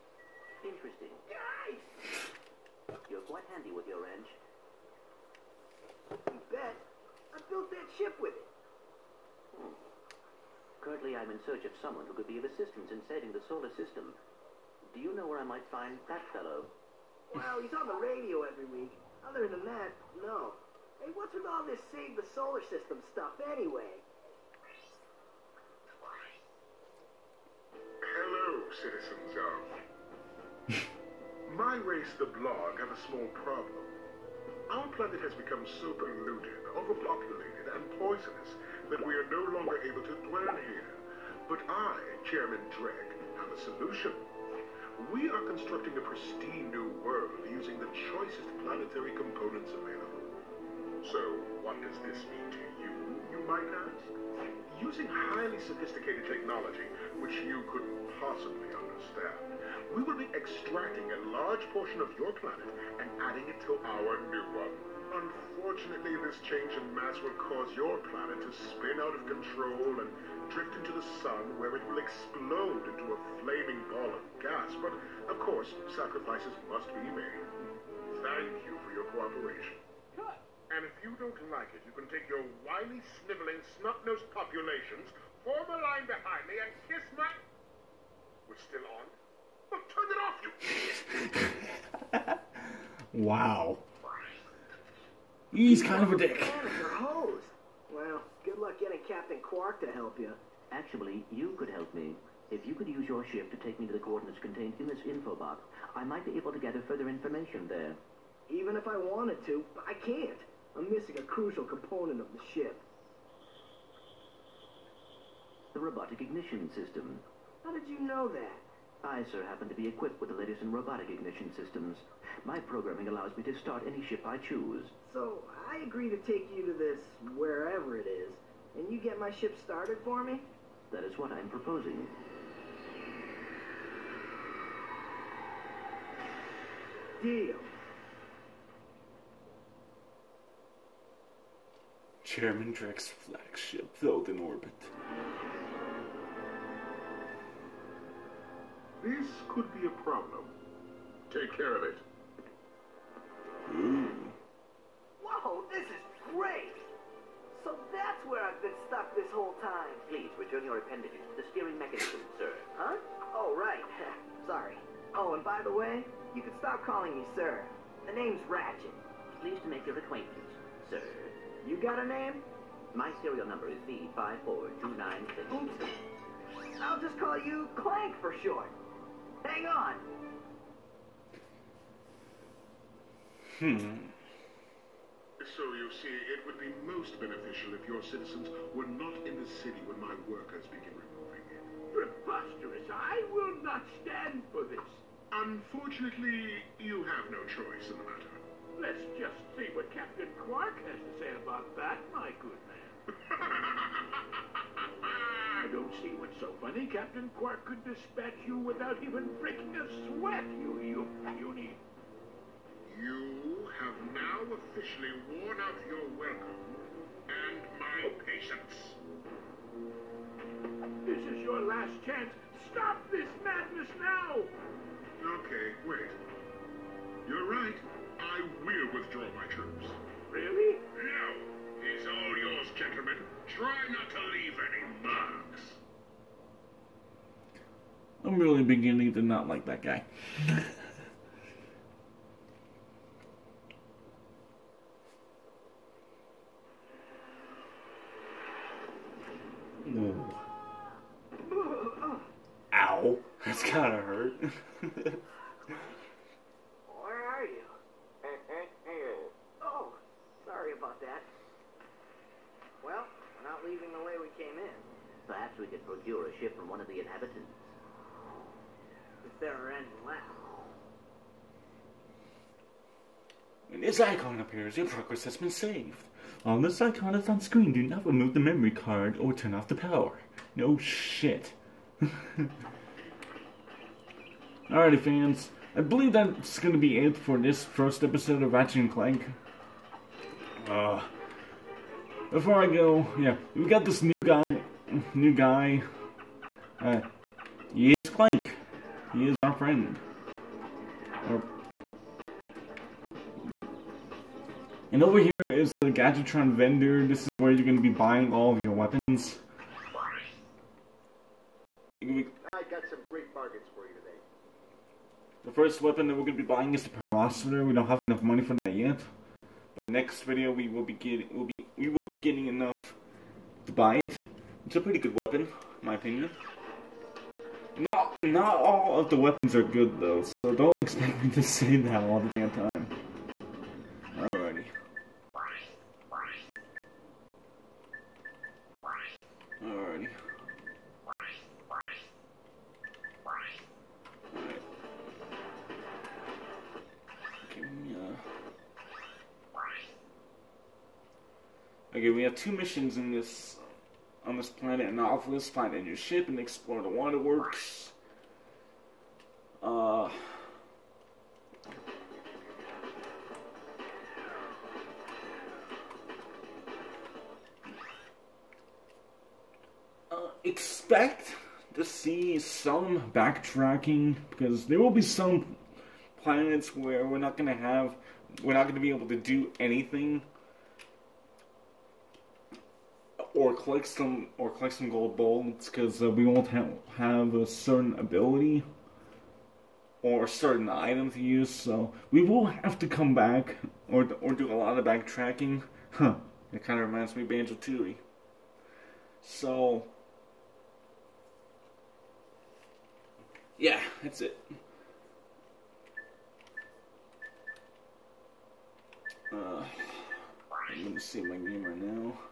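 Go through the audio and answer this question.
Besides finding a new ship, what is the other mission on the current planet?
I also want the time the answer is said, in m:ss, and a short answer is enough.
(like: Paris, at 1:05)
explore the waterworks, at 5:56.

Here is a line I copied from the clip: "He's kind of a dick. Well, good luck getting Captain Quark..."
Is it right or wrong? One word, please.
right.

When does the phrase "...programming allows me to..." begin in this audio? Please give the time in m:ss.
2:02.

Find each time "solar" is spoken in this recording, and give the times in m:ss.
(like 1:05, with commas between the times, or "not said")
0:13, 0:22.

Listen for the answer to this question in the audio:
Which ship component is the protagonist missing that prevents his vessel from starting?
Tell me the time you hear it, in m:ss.
1:55.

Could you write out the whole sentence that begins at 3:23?
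I don't see what's so funny.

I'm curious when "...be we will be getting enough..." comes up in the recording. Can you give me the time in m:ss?
5:21.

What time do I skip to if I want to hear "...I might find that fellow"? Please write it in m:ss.
0:15.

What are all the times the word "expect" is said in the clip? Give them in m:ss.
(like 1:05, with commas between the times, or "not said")
5:30, 6:10.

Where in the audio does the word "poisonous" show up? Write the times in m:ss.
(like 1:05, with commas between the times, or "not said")
0:37.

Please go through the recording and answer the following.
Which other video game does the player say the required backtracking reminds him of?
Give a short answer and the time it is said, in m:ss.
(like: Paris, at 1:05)
Banjo Tooie, at 6:37.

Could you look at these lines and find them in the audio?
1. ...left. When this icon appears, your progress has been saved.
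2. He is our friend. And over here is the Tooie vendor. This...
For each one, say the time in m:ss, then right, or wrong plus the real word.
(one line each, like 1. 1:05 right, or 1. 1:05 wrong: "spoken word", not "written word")
1. 4:30 right
2. 4:59 wrong: "Gadgetron", not "Tooie".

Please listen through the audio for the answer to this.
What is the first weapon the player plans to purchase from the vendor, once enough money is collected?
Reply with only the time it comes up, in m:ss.
5:16.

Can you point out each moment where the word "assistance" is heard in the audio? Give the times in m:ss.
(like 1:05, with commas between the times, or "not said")
0:12.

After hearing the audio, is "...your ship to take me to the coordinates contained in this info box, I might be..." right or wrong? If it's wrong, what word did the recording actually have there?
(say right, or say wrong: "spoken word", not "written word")
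right.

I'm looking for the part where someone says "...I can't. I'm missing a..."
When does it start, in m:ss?
1:49.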